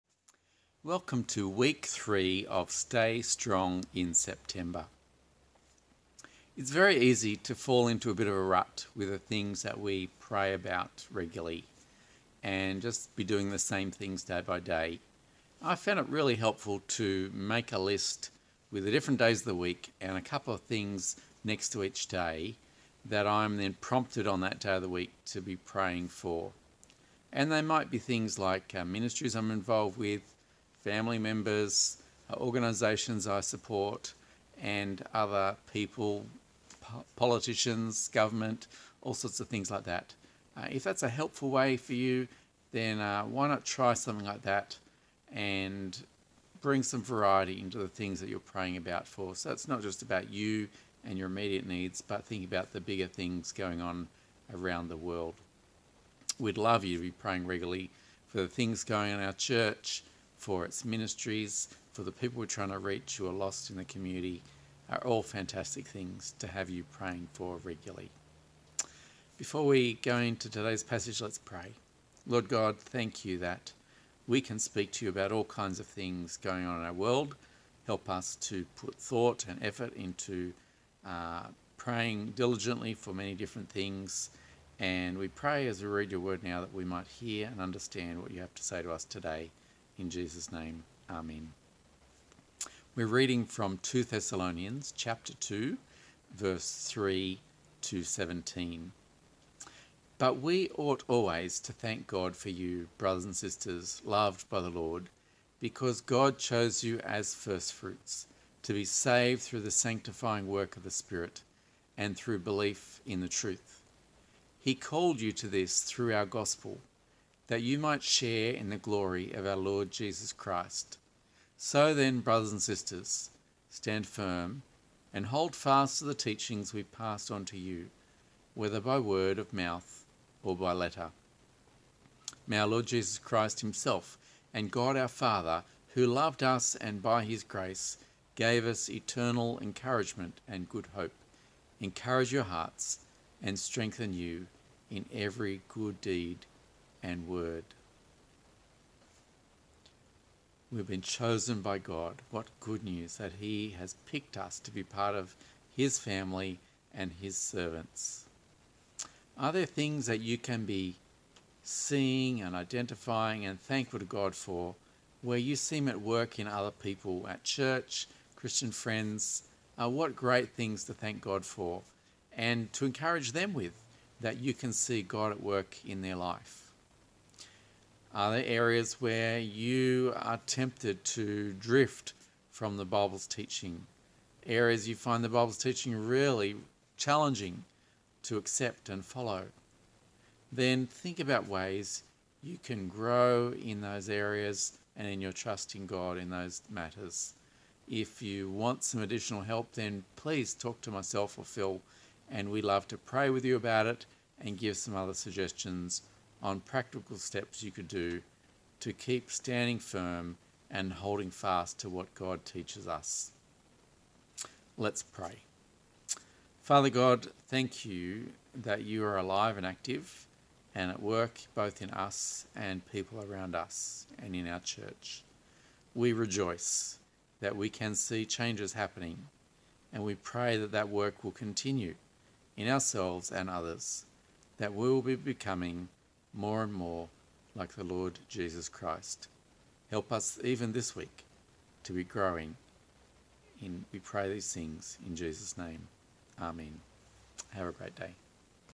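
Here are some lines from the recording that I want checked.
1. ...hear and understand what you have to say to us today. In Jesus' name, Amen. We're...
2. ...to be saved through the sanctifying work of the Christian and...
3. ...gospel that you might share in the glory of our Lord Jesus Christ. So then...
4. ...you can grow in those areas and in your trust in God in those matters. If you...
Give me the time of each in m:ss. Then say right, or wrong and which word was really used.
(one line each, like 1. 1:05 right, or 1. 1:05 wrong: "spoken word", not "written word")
1. 1:27 right
2. 1:48 wrong: "Spirit", not "Christian"
3. 1:56 right
4. 3:12 right.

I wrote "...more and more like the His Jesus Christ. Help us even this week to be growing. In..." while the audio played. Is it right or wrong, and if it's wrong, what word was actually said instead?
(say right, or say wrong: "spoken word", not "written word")
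wrong: "Lord", not "His".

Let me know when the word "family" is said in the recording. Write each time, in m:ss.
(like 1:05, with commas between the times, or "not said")
0:30, 2:35.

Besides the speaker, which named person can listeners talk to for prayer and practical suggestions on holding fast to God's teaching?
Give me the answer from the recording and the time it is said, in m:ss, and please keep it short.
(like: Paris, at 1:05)
Phil, at 3:21.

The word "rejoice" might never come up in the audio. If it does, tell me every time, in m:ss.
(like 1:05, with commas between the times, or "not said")
3:46.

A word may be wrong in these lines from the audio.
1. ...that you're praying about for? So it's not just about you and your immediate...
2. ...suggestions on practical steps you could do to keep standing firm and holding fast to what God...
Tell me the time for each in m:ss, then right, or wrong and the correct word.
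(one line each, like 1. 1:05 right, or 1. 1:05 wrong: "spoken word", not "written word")
1. 0:48 right
2. 3:25 right.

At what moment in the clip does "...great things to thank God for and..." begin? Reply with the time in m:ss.
2:50.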